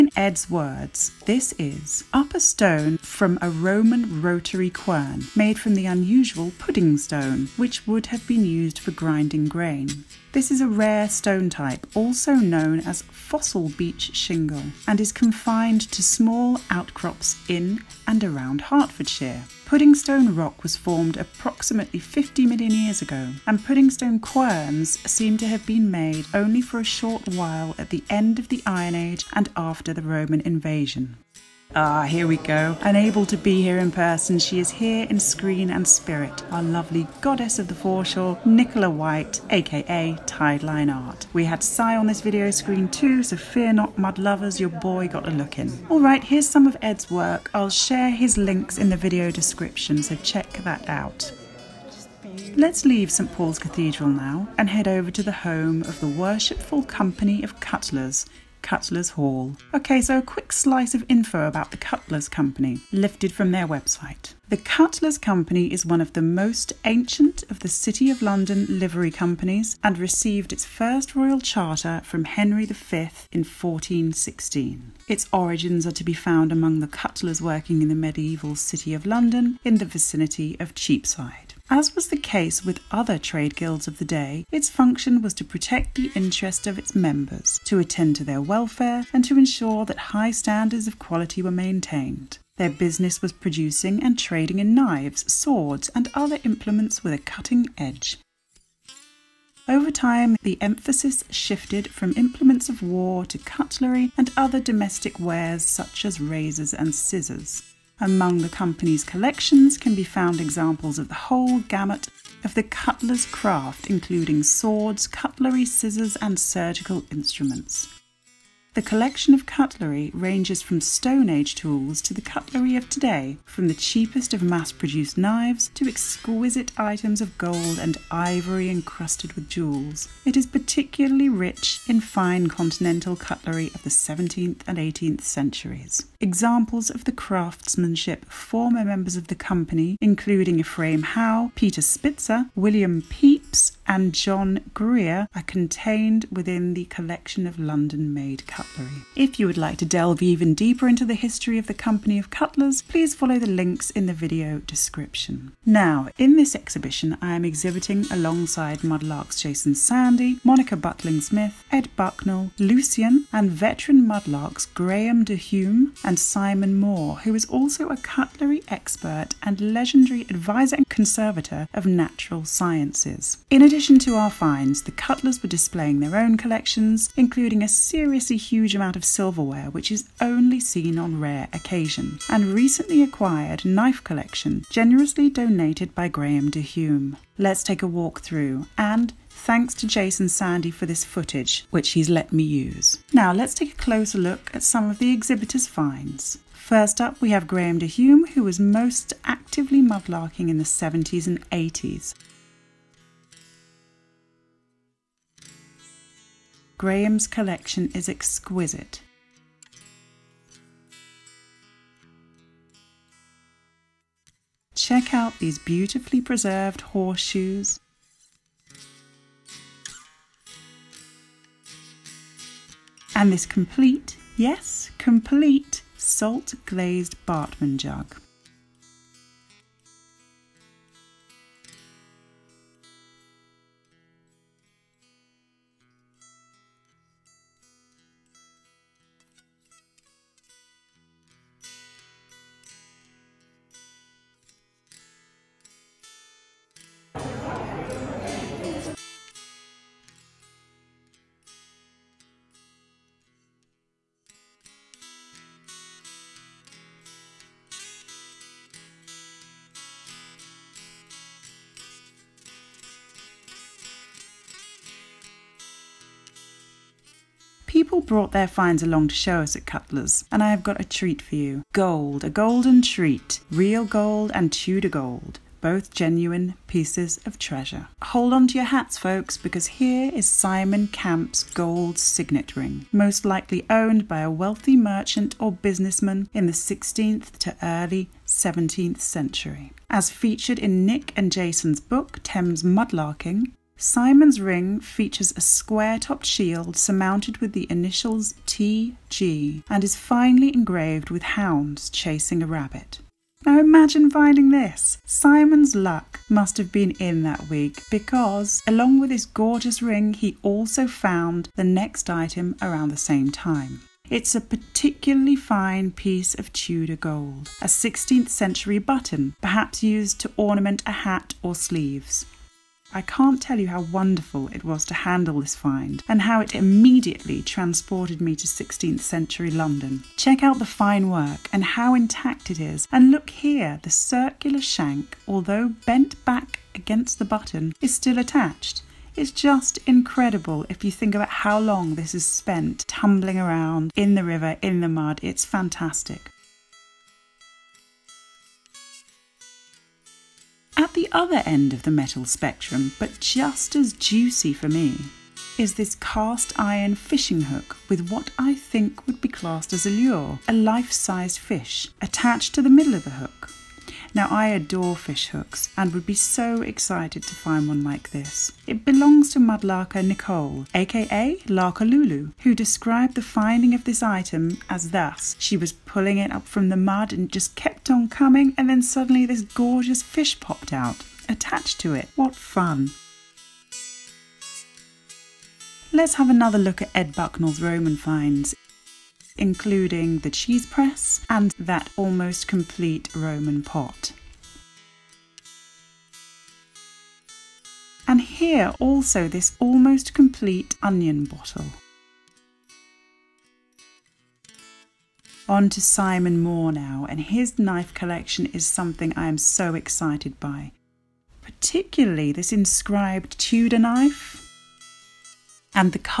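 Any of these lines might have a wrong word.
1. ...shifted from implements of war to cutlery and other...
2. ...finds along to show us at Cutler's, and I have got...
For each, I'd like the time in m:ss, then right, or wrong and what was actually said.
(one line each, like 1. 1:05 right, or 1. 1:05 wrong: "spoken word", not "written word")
1. 1:41 right
2. 4:28 right.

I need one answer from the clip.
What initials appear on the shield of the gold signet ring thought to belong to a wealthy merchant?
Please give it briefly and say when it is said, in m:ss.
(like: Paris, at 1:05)
TG, at 4:58.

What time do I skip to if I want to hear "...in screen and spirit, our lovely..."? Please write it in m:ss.
0:35.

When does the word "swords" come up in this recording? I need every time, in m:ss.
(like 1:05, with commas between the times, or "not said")
1:35, 1:54.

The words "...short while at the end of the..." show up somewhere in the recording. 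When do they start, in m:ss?
0:26.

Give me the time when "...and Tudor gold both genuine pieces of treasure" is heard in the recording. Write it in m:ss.
4:34.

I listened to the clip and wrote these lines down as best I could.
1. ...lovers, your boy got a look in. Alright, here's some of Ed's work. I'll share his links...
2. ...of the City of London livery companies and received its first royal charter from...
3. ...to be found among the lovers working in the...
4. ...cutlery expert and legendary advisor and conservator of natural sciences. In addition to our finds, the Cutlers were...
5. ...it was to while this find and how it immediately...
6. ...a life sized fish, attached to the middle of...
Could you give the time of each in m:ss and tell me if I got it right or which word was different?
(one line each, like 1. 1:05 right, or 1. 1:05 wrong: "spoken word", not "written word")
1. 0:44 right
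2. 1:07 right
3. 1:15 wrong: "cutlers", not "lovers"
4. 2:47 right
5. 5:24 wrong: "handle", not "while"
6. 6:00 right.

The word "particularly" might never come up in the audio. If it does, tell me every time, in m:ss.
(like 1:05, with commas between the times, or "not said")
2:10, 5:14, 6:51.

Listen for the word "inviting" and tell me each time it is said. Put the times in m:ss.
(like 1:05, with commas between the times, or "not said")
not said.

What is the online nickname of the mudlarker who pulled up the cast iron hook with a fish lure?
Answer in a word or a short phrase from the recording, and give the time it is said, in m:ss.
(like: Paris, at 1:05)
Larker Lulu, at 6:11.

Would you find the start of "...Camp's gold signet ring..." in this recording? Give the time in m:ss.
4:40.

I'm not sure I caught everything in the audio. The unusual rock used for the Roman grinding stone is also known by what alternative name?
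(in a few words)
fossil beach shingle.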